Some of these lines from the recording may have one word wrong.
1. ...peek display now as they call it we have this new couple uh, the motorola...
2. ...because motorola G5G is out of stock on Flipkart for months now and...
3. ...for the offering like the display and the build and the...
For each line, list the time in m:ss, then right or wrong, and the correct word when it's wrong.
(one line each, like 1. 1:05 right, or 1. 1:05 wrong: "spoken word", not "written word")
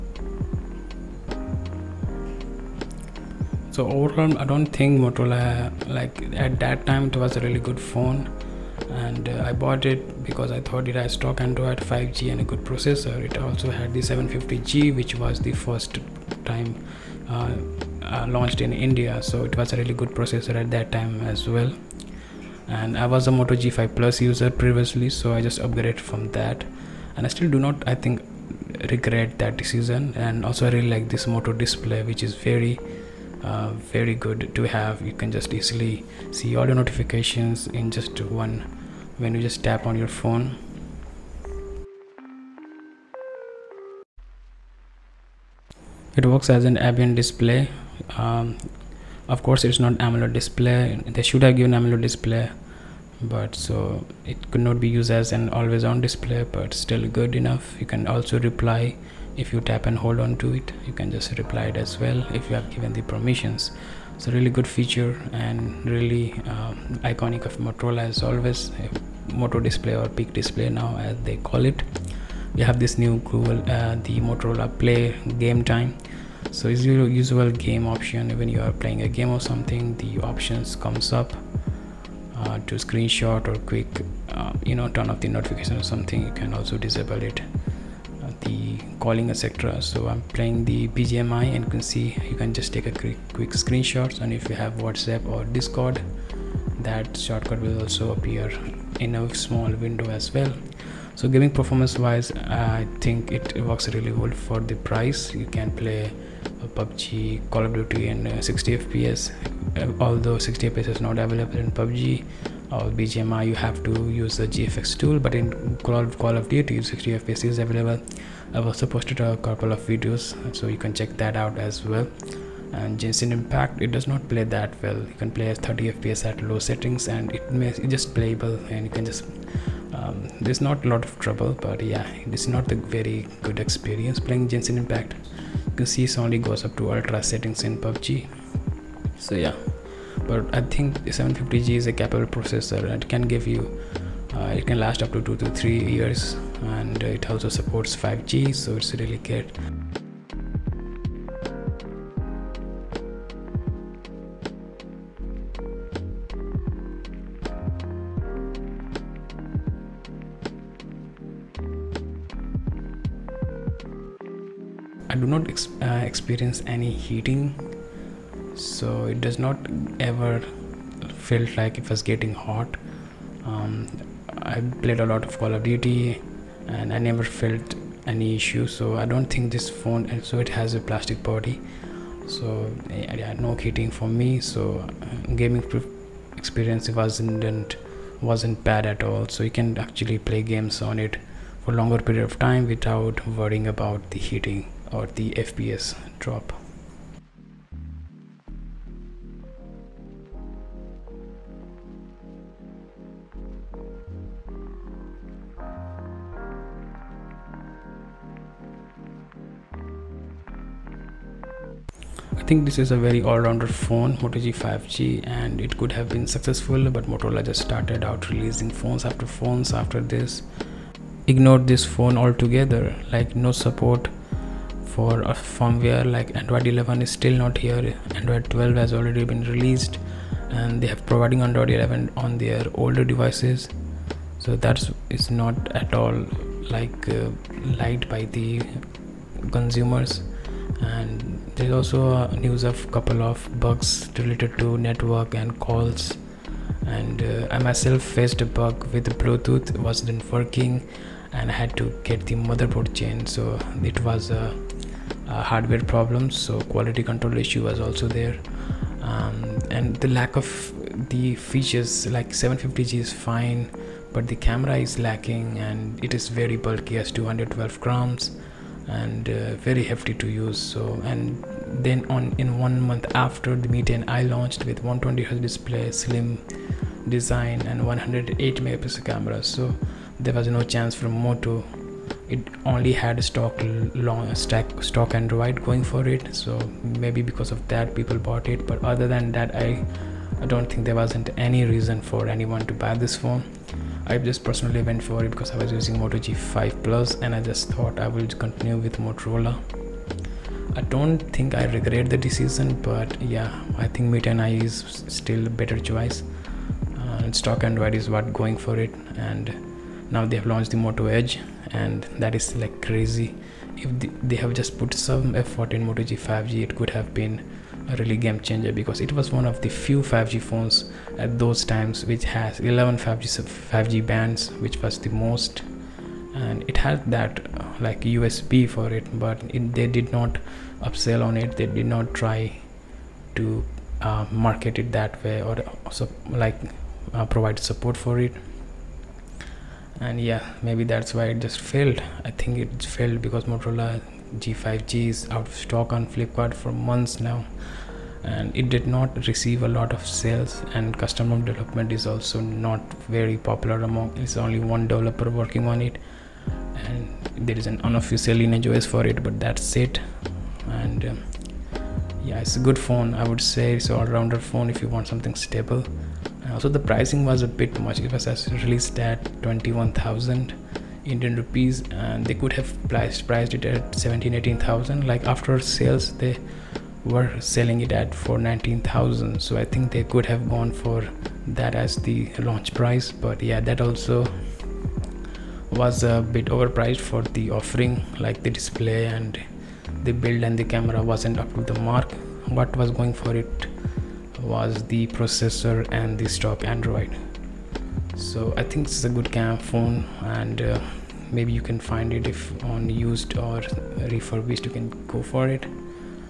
1. 1:10 wrong: "google", not "couple"
2. 5:43 right
3. 6:27 right.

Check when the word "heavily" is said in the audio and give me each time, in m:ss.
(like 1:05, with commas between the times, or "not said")
not said.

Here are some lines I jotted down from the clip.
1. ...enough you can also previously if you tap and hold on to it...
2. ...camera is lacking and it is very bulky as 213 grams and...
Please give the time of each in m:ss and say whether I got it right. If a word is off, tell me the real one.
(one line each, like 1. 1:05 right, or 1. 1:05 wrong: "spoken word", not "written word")
1. 0:57 wrong: "reply", not "previously"
2. 4:24 wrong: "212", not "213".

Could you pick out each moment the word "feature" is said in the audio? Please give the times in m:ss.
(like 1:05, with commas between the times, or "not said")
1:04, 4:21.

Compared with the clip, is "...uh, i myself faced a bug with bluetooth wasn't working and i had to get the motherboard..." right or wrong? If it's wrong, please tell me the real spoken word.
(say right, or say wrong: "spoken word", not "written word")
right.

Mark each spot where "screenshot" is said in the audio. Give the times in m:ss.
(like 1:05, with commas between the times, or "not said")
1:22, 1:33.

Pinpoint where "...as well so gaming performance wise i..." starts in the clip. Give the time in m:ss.
1:40.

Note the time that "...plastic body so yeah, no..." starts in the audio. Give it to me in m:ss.
3:00.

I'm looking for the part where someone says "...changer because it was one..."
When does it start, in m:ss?
5:18.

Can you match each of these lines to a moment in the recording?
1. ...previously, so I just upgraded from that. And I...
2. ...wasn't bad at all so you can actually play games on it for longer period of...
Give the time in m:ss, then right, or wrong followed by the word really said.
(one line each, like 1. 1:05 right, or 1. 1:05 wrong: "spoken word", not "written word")
1. 0:24 right
2. 3:08 right.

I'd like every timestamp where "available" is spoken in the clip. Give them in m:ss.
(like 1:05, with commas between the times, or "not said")
1:51, 1:57.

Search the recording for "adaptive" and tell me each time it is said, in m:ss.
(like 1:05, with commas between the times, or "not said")
not said.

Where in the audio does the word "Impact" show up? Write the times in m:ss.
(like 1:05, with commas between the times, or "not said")
2:03, 2:14.